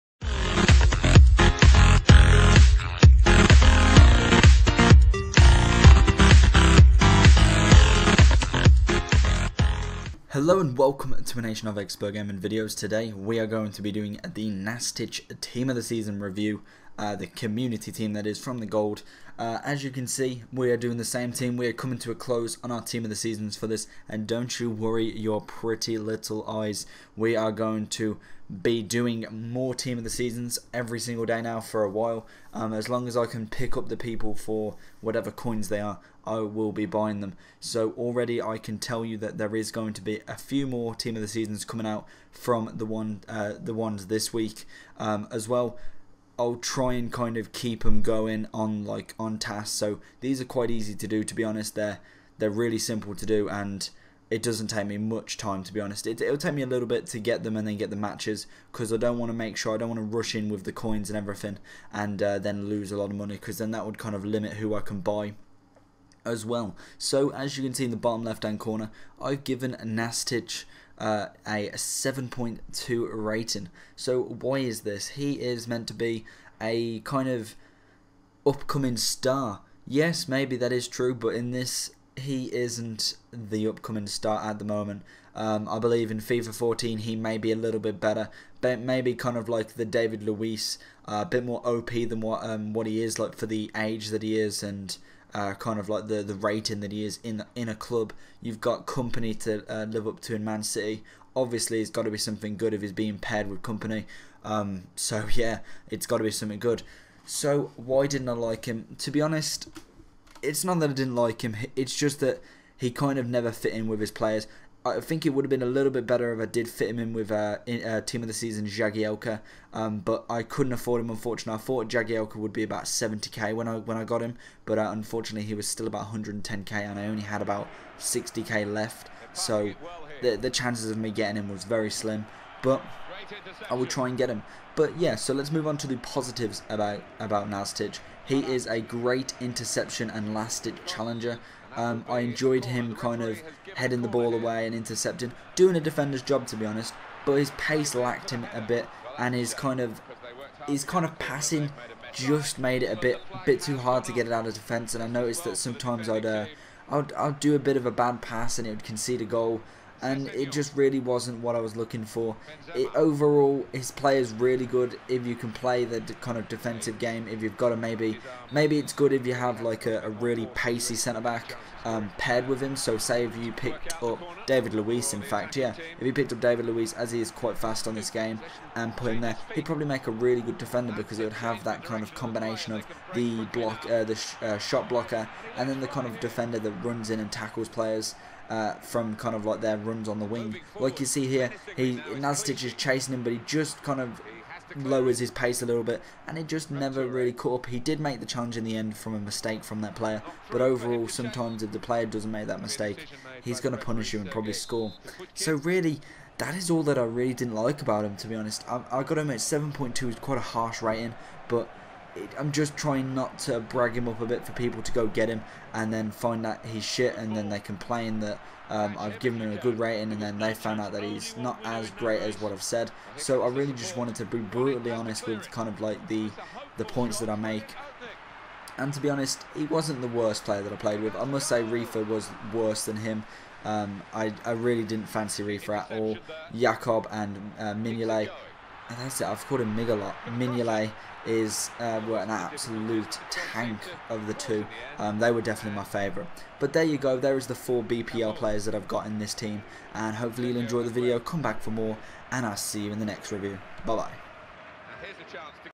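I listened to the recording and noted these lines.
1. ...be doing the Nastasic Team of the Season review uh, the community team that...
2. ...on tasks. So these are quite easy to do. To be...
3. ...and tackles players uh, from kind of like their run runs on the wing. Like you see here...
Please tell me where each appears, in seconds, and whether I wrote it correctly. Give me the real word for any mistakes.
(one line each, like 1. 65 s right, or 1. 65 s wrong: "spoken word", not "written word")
1. 13 s right
2. 49 s right
3. 187 s right.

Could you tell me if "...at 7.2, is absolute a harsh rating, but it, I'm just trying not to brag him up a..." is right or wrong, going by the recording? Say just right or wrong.
wrong.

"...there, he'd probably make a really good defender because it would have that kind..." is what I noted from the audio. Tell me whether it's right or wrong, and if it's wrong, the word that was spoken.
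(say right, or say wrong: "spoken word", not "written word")
right.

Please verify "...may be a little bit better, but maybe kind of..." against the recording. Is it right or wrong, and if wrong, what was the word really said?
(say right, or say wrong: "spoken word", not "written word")
right.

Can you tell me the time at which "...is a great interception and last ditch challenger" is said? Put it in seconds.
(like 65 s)
138 s.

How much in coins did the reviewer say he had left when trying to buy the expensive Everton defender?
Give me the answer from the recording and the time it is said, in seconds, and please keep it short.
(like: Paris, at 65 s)
60k, at 127 s.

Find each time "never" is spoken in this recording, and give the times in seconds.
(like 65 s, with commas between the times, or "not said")
113 s, 196 s.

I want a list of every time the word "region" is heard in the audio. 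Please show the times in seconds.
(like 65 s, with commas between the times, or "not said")
not said.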